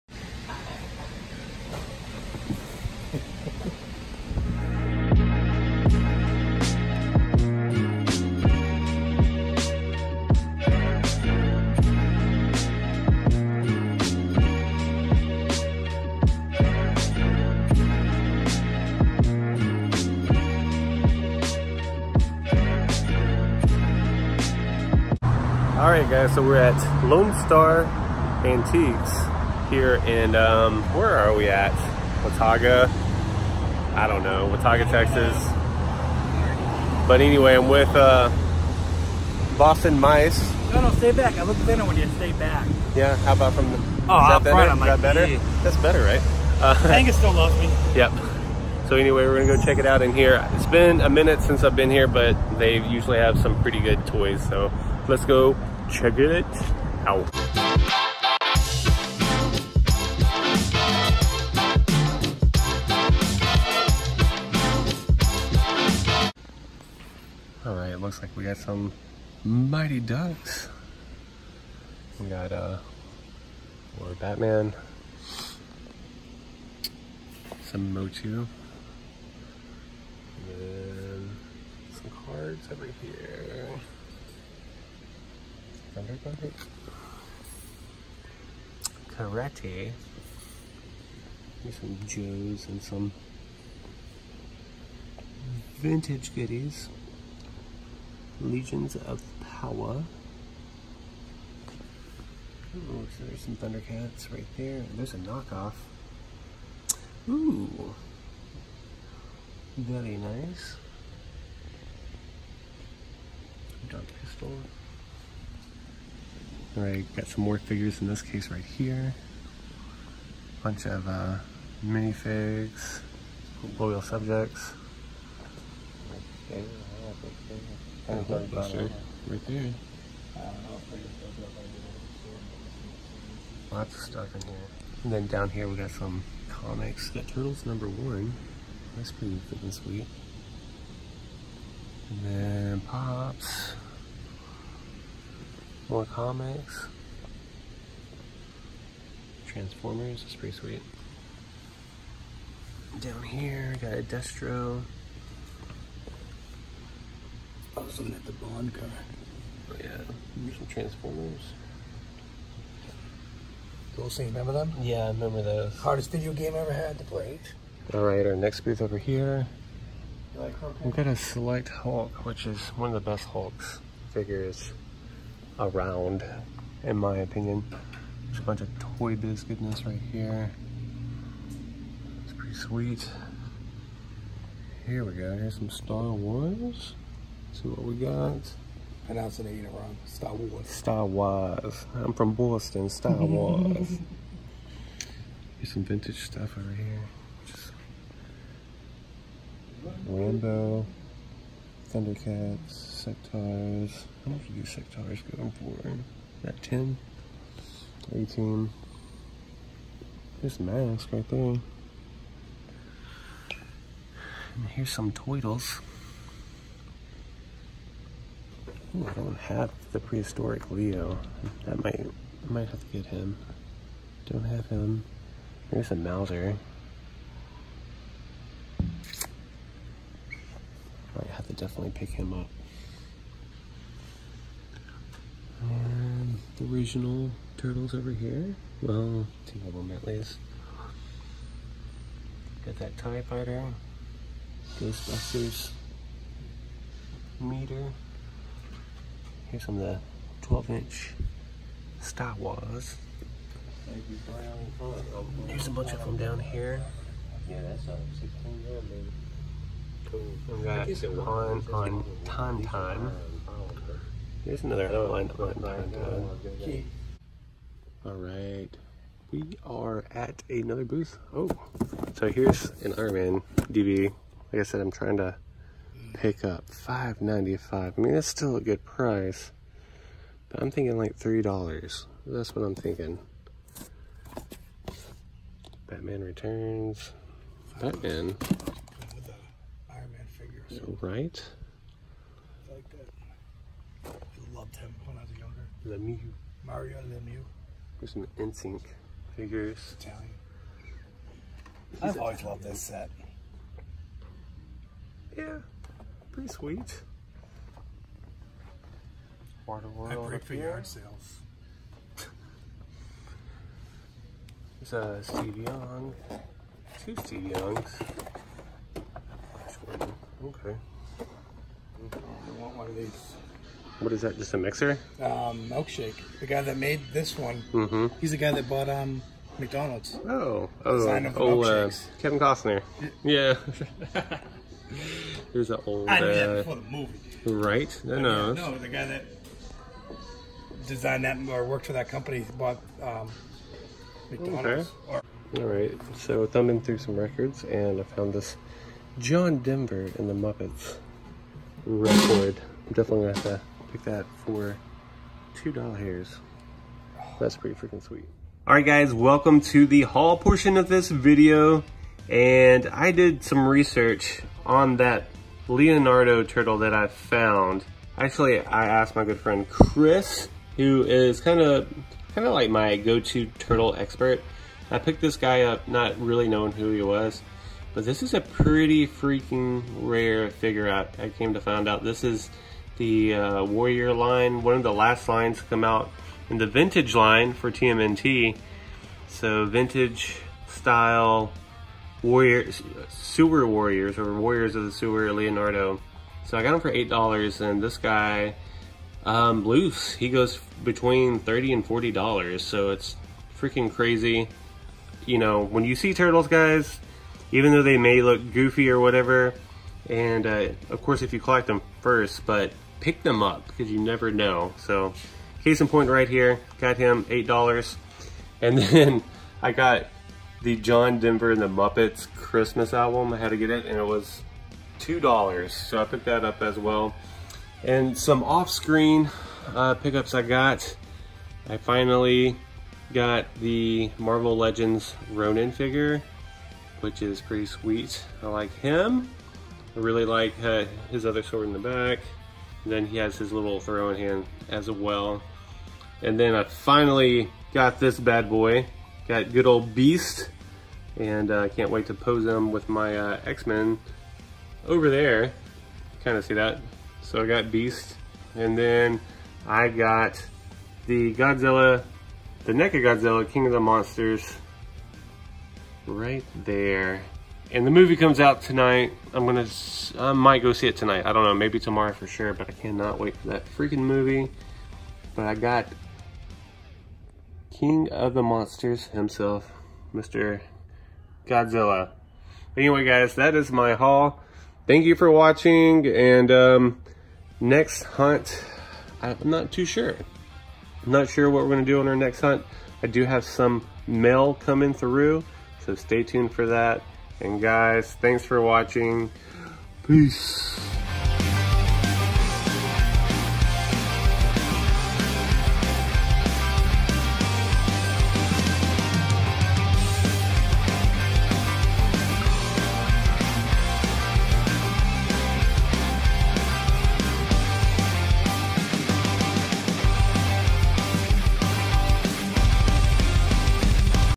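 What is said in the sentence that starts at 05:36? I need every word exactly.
I knew that uh, before the movie.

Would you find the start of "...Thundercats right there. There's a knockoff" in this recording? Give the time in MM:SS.
01:43.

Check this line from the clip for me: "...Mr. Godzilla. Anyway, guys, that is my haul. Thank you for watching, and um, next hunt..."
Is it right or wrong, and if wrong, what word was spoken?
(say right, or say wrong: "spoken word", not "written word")
right.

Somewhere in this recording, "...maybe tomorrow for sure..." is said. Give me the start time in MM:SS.
07:51.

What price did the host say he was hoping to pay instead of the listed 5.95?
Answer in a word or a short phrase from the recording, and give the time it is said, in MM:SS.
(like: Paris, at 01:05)
$3, at 04:41.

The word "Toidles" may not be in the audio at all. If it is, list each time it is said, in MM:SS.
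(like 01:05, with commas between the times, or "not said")
03:35.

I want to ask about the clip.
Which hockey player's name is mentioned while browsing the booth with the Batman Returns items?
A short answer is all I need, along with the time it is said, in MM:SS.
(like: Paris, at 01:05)
Mario Lemieux, at 04:56.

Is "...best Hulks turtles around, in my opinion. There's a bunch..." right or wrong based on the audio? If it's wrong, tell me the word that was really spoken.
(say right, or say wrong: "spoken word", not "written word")
wrong: "figures", not "turtles".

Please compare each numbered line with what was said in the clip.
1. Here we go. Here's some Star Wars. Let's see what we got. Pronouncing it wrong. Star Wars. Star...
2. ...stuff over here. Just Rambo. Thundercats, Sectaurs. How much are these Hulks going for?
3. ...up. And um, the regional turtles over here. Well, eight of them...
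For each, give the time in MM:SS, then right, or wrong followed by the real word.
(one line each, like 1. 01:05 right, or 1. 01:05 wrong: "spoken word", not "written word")
1. 03:04 right
2. 03:16 wrong: "Sectaurs", not "Hulks"
3. 03:52 wrong: "two", not "eight".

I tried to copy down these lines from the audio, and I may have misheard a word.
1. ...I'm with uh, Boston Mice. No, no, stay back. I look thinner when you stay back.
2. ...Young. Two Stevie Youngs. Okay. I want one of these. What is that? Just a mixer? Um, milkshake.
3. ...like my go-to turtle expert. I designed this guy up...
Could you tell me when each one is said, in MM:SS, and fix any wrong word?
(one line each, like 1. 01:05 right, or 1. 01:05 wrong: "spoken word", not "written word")
1. 00:37 right
2. 05:15 right
3. 06:12 wrong: "picked", not "designed".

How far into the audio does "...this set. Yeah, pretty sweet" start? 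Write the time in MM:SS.
05:02.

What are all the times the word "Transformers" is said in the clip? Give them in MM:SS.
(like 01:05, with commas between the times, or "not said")
02:29, 02:40.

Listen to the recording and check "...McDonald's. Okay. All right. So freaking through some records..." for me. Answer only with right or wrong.
wrong.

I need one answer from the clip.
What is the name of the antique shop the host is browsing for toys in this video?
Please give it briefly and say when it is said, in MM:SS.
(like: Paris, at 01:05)
Lone Star Antiques, at 00:27.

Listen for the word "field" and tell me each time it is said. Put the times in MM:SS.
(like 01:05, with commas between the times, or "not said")
not said.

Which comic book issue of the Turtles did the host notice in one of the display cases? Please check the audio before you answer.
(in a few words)
Number one.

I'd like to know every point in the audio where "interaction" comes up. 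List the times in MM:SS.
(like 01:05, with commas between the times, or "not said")
not said.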